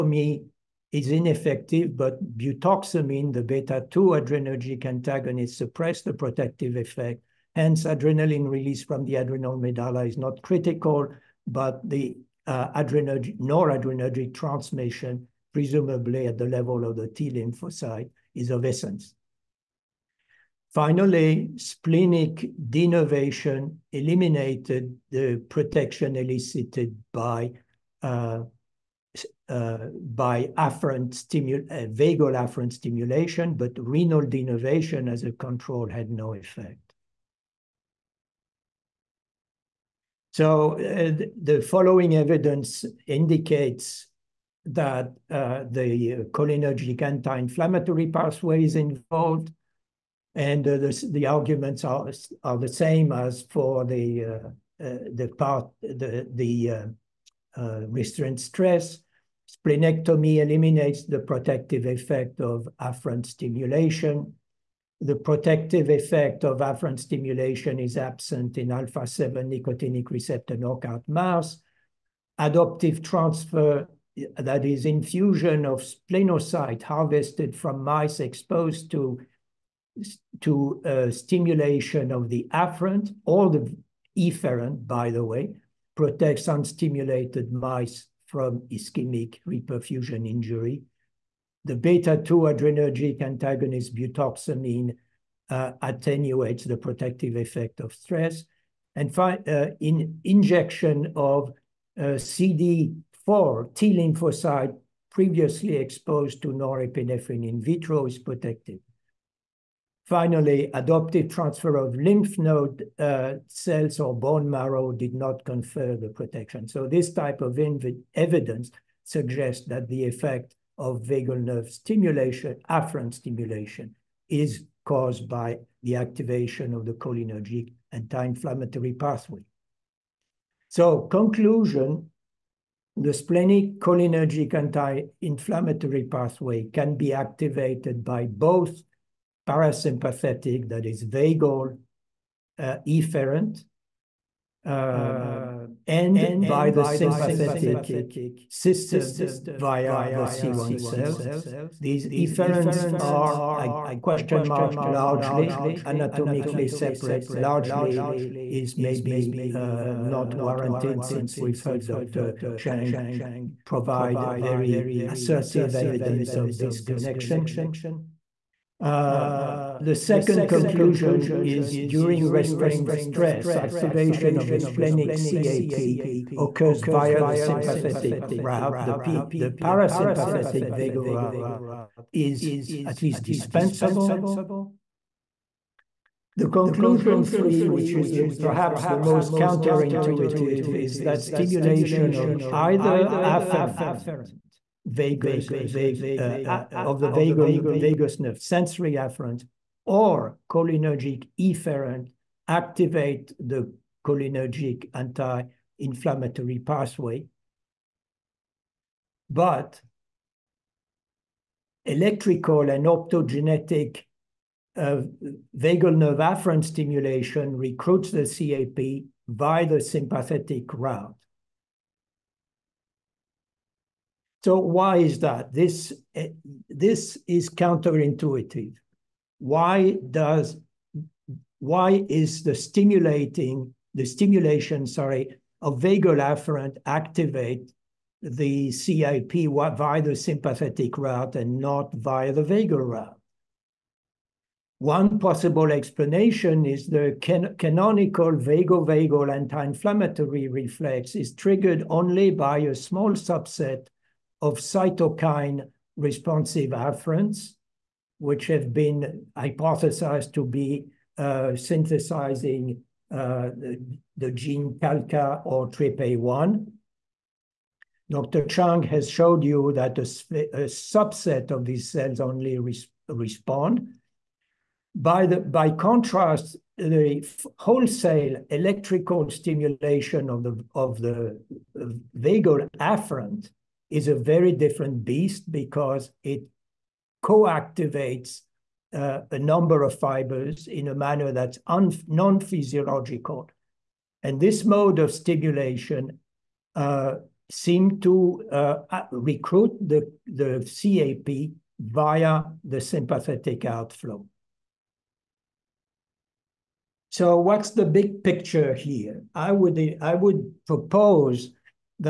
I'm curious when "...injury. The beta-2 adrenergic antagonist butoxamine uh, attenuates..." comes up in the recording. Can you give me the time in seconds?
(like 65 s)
90 s.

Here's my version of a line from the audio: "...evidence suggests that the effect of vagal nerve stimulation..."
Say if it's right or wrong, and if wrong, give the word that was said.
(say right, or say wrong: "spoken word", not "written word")
right.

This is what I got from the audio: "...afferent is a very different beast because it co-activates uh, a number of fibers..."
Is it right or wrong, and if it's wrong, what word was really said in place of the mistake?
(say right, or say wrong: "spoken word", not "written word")
right.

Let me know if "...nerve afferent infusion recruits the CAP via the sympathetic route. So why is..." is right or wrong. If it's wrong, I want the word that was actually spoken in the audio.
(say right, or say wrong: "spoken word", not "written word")
wrong: "stimulation", not "infusion".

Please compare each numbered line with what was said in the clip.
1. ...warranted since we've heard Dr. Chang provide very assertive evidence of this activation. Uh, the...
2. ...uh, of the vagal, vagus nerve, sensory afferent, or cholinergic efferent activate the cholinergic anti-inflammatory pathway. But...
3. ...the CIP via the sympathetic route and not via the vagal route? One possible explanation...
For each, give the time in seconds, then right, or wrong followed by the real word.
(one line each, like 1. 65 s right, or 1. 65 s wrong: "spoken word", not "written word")
1. 160 s wrong: "connection", not "activation"
2. 196 s right
3. 238 s right.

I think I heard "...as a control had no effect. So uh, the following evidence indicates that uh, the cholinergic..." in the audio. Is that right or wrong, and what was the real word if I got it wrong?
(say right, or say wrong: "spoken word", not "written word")
right.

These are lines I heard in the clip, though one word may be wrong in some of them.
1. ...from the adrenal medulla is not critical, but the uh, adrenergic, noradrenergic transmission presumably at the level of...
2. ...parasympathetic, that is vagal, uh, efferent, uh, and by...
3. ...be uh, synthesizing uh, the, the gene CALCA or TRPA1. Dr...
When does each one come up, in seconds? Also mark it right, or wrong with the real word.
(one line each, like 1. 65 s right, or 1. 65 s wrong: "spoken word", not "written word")
1. 8 s right
2. 139 s right
3. 260 s right.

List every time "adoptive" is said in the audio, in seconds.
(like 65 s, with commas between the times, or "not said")
72 s, 110 s.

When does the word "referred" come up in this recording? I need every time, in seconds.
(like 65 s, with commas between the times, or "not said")
not said.